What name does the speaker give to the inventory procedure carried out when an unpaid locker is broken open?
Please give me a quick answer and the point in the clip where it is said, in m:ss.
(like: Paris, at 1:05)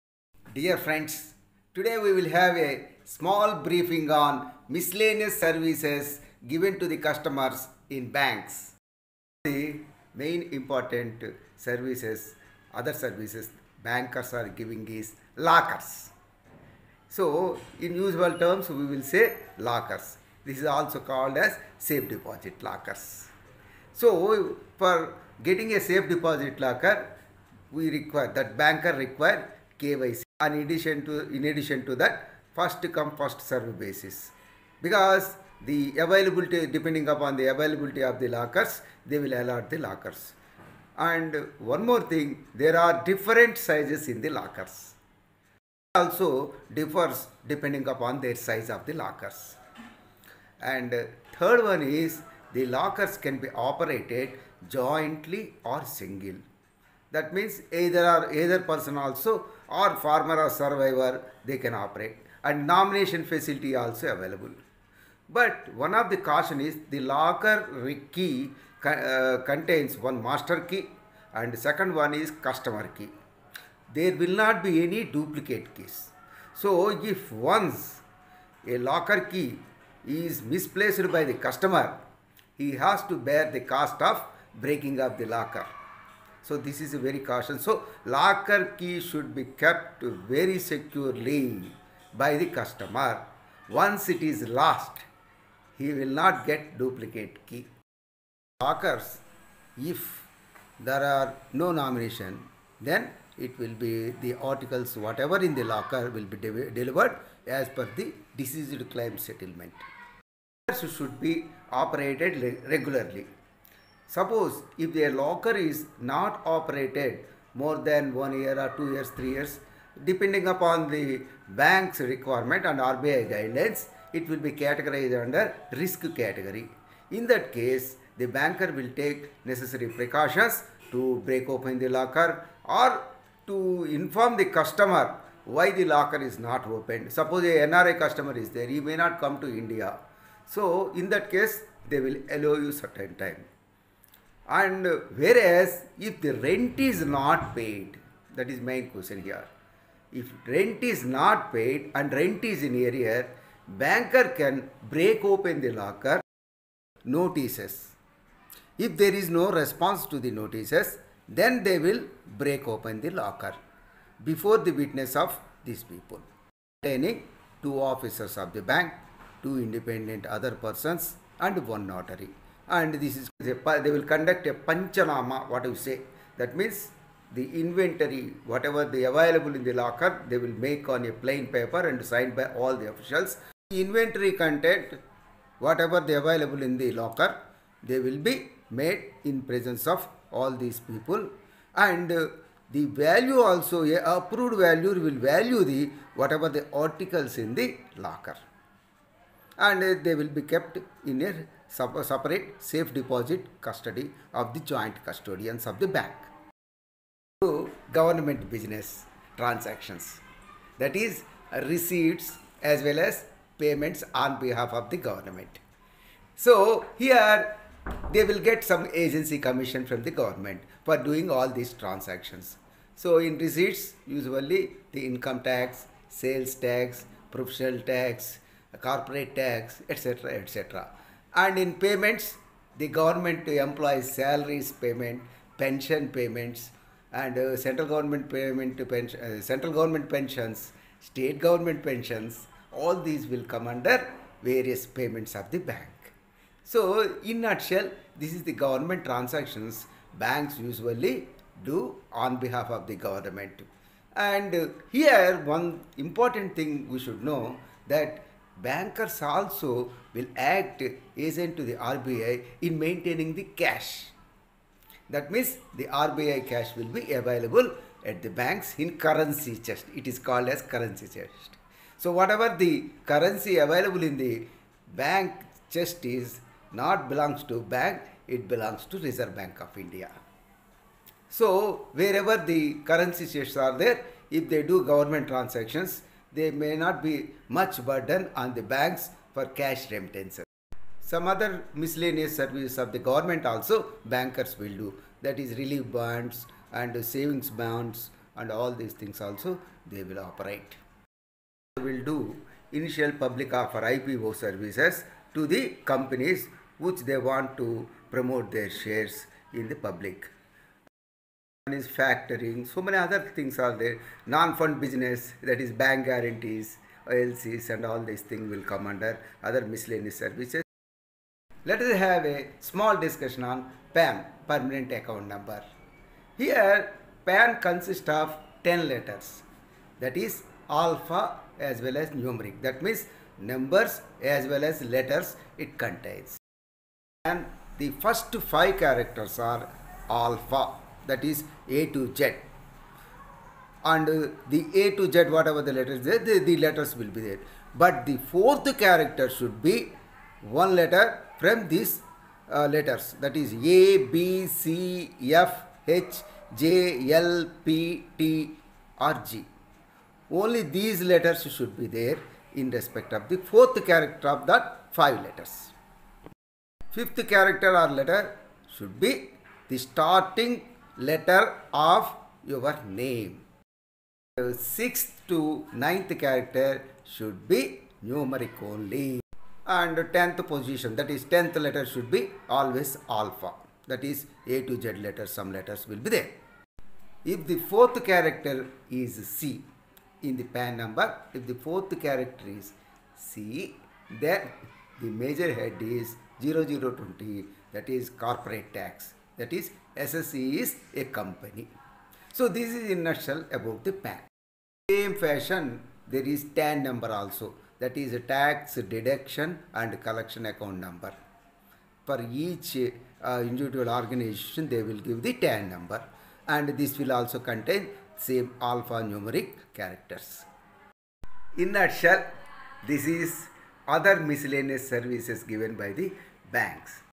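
panchanama, at 2:54.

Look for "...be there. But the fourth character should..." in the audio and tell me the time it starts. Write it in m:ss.
5:47.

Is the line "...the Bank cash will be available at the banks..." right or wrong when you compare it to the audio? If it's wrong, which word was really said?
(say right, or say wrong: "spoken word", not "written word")
wrong: "RBI", not "Bank".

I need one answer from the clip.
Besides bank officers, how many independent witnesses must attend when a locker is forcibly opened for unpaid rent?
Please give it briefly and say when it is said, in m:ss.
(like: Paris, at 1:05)
2, at 2:49.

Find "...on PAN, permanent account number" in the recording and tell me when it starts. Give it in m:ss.
5:23.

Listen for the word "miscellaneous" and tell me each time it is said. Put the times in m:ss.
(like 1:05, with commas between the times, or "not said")
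0:04, 4:51, 5:19, 7:04.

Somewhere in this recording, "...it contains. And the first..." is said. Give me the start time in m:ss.
5:35.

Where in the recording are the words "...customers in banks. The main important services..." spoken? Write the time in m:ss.
0:06.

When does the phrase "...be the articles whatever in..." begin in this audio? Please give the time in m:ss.
1:43.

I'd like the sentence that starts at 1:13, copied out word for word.
There will not be any duplicate keys.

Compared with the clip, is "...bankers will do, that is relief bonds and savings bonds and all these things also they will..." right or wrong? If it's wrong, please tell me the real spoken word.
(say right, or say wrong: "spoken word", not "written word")
right.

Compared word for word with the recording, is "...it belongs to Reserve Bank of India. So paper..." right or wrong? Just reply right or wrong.
wrong.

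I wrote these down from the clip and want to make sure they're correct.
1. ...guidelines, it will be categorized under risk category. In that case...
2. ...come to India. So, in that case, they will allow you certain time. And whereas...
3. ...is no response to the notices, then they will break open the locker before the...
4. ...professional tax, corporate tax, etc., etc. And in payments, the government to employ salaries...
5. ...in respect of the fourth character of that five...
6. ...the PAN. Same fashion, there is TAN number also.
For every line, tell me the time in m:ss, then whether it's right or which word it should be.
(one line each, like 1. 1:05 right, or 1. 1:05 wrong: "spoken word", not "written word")
1. 2:03 right
2. 2:19 right
3. 2:39 right
4. 3:47 right
5. 6:02 right
6. 6:43 right.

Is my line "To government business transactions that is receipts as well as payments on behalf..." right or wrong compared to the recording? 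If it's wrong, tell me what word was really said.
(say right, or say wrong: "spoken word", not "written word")
right.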